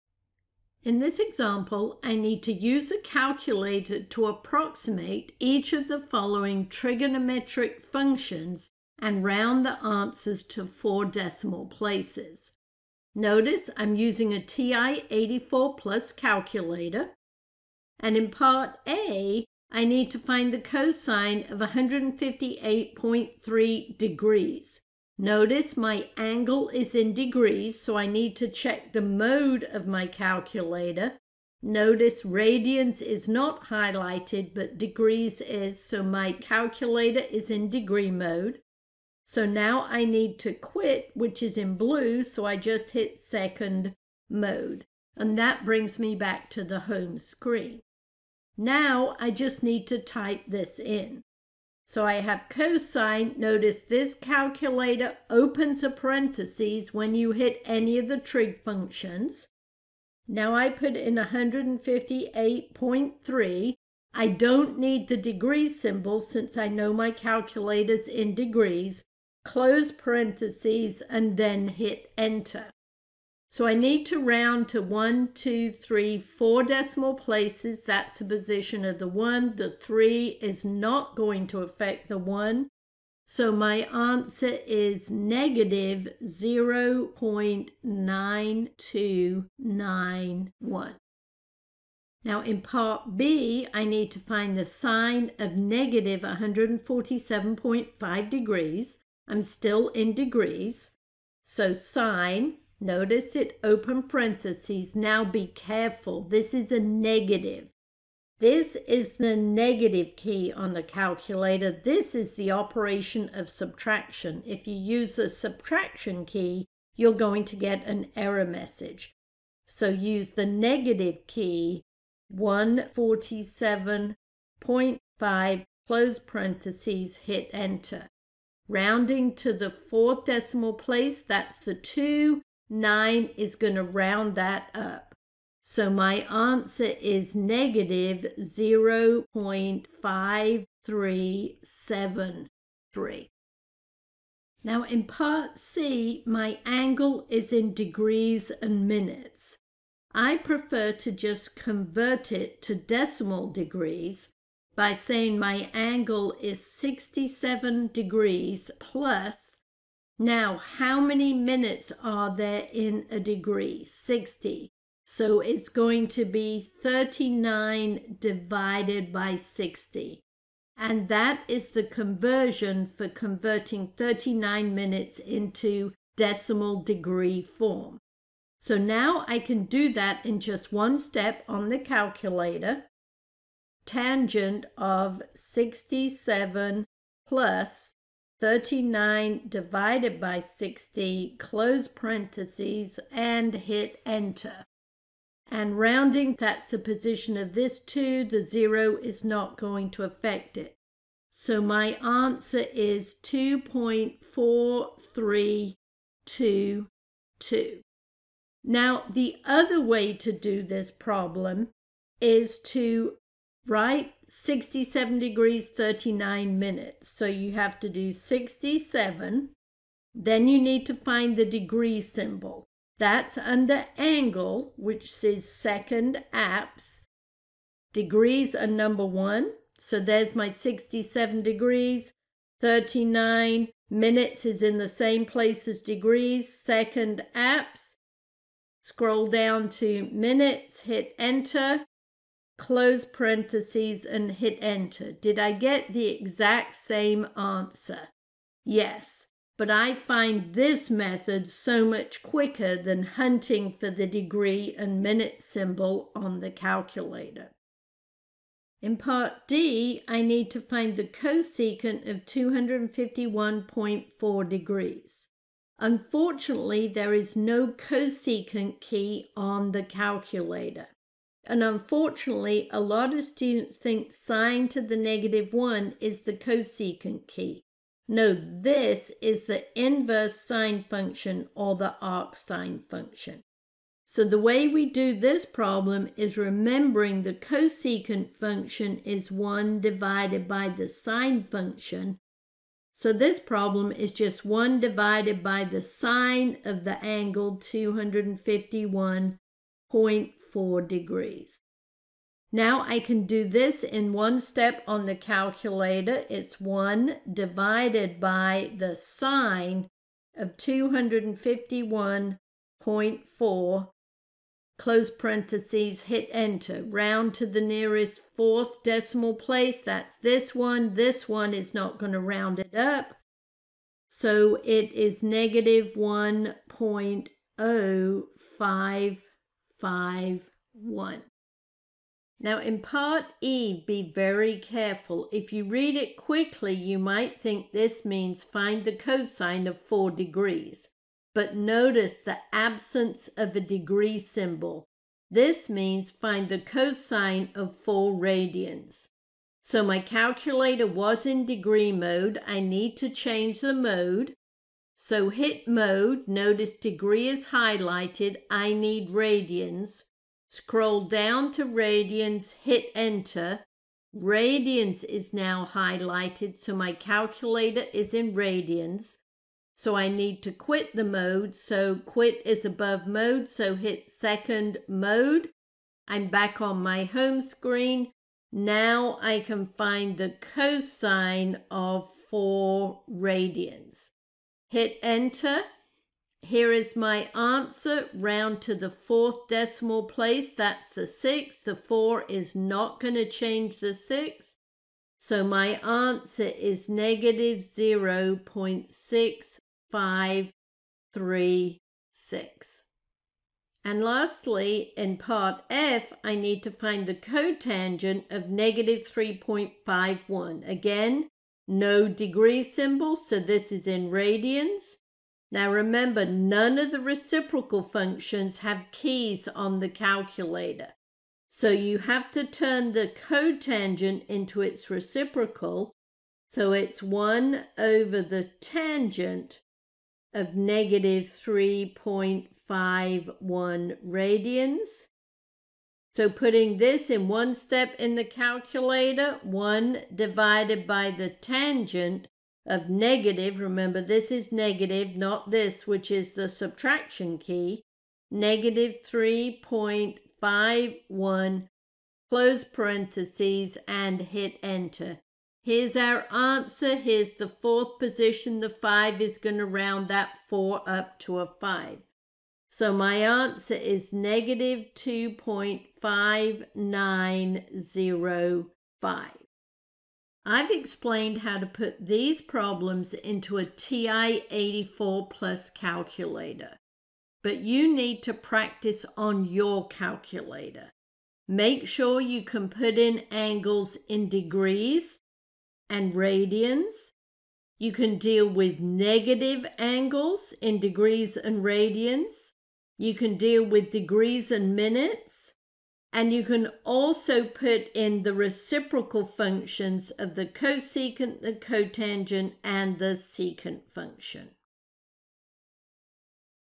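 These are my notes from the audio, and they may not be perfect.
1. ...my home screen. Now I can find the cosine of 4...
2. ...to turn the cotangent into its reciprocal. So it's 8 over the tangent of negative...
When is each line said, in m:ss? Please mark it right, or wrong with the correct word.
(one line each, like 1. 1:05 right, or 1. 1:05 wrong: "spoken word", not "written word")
1. 6:16 right
2. 7:02 wrong: "1", not "8".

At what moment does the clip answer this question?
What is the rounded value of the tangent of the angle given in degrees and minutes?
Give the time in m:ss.
3:23.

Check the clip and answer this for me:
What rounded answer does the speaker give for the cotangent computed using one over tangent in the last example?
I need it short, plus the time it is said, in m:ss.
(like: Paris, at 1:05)
-2.5905, at 7:44.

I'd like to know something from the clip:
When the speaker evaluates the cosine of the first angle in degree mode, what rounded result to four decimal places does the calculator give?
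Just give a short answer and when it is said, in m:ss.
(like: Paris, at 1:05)
-0.9291, at 1:25.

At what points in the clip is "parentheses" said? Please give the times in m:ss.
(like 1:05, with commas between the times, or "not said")
0:55, 1:09, 1:44, 2:06, 3:11, 4:03, 5:15, 7:32.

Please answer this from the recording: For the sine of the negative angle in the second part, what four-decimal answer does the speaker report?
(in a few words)
-0.5373.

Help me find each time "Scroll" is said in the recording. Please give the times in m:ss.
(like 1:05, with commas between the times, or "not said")
3:58, 6:00.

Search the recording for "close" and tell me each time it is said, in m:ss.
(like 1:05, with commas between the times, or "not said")
1:09, 2:05, 3:11, 4:02, 5:14, 7:32.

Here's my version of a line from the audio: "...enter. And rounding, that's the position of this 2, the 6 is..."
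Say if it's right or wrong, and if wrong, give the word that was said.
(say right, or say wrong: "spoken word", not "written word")
wrong: "0", not "6".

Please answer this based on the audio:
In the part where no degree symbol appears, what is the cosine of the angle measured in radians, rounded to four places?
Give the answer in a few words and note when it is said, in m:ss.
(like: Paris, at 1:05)
-0.6536, at 6:36.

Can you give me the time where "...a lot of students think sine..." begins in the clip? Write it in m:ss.
4:32.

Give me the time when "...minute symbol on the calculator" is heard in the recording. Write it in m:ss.
4:15.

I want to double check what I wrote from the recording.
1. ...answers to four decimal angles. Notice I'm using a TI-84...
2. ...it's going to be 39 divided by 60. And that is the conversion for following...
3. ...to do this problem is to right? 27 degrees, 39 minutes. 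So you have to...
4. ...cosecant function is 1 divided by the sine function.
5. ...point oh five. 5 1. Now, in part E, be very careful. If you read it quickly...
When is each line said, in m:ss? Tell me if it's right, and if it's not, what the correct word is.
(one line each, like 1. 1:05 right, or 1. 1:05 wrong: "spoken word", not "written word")
1. 0:09 wrong: "places", not "angles"
2. 2:45 wrong: "converting", not "following"
3. 3:30 wrong: "67", not "27"
4. 4:47 right
5. 5:26 right.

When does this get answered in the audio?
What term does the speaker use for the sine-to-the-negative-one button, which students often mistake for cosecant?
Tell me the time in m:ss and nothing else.
4:41.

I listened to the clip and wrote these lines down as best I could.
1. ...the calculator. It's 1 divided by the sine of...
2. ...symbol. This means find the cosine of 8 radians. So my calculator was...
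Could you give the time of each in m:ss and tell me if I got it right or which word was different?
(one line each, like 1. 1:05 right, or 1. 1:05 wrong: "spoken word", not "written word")
1. 5:05 right
2. 5:44 wrong: "4", not "8".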